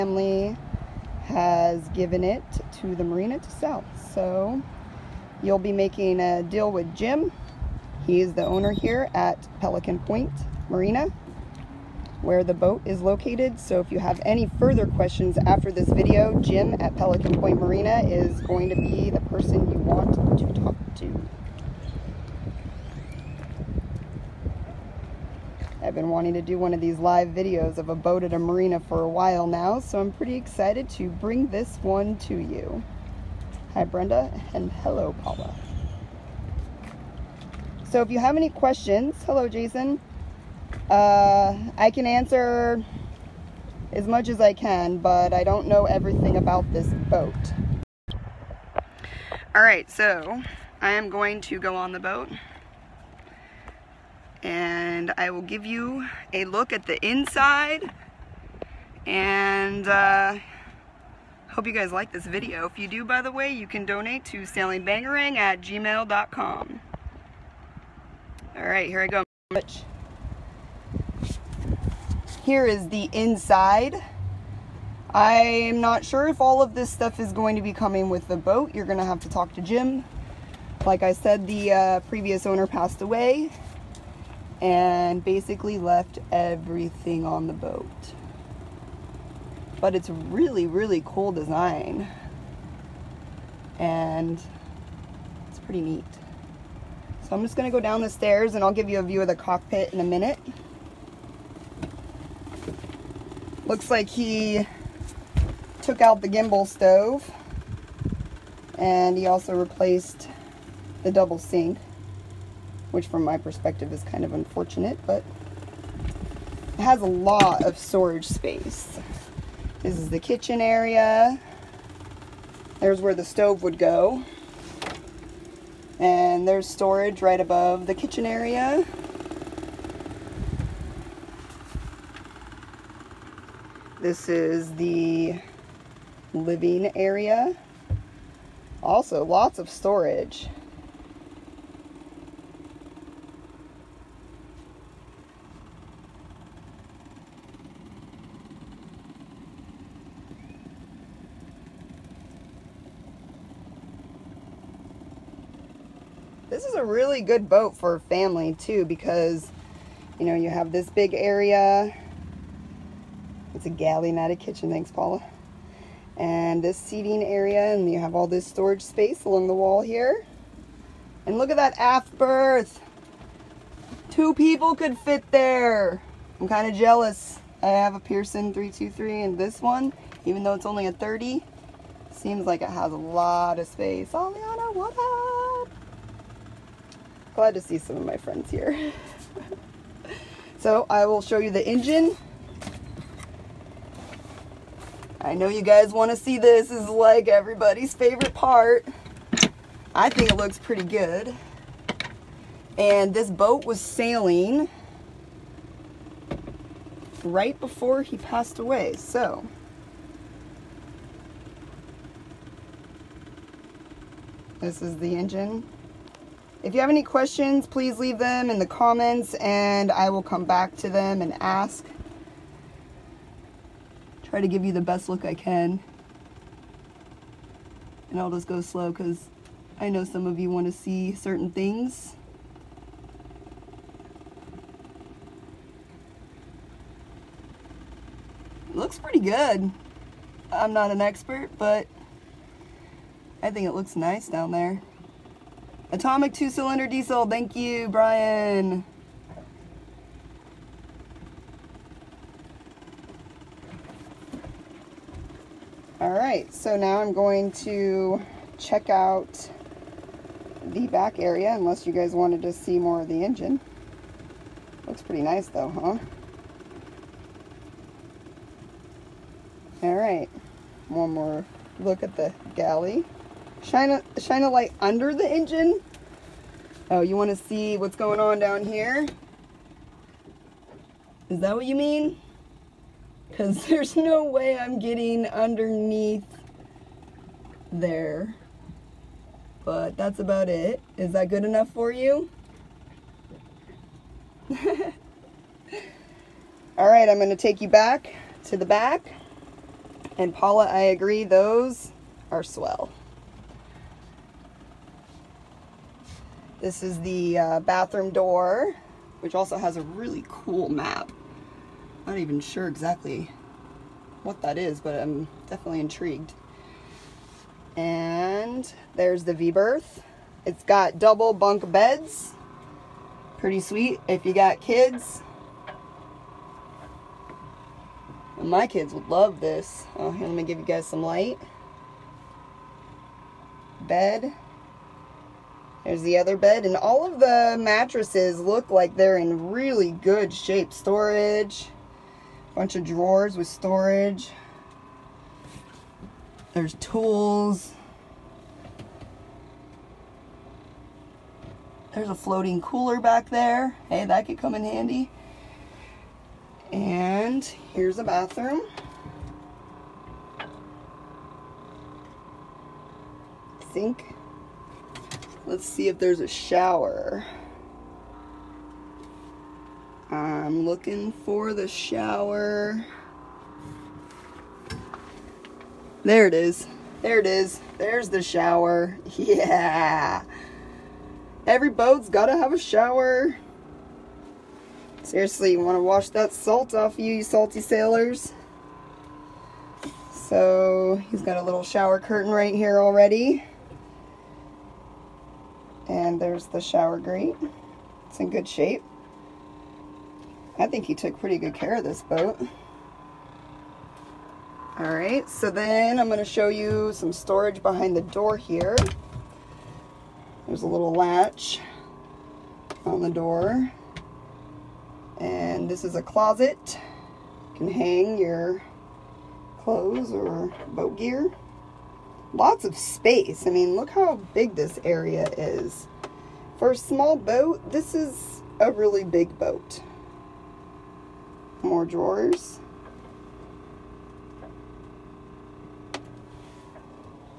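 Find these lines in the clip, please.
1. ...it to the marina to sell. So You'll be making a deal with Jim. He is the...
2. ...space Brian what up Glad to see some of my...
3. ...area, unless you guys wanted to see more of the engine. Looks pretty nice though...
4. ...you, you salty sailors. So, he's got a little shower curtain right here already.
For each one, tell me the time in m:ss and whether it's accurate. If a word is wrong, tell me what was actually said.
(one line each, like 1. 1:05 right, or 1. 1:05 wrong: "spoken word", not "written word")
1. 0:02 right
2. 3:03 wrong: "Aliana", not "Brian"
3. 4:21 right
4. 6:26 right.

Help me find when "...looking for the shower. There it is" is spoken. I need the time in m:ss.
6:10.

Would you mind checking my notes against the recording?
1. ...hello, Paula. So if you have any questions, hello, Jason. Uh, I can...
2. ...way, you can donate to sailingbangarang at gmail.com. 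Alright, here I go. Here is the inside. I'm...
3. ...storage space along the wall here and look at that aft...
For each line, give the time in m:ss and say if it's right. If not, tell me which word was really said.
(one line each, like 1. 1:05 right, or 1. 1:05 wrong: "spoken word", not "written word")
1. 0:34 right
2. 1:03 right
3. 2:48 right.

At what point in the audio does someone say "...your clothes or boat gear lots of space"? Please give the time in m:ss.
6:58.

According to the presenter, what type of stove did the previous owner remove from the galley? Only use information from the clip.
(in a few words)
gimbal stove.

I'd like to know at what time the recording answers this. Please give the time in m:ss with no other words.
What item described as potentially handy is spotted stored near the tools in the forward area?
5:52.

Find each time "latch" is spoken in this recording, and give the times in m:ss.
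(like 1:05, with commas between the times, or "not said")
6:50.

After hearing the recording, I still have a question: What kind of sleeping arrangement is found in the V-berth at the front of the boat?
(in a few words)
double bunk beds.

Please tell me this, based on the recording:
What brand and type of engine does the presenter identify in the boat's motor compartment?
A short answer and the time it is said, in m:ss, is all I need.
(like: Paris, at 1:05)
Atomic two-cylinder diesel, at 4:05.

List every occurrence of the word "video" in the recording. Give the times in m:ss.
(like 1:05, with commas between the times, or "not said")
0:15, 0:27, 1:02.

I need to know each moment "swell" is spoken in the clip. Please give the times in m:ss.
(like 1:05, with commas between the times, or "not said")
5:02.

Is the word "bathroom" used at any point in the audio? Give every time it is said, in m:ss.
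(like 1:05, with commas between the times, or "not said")
5:07, 5:58.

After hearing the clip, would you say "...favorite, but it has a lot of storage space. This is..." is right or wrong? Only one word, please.
wrong.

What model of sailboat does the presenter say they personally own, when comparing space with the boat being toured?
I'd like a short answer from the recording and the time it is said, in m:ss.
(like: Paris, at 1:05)
Pearson 323, at 2:58.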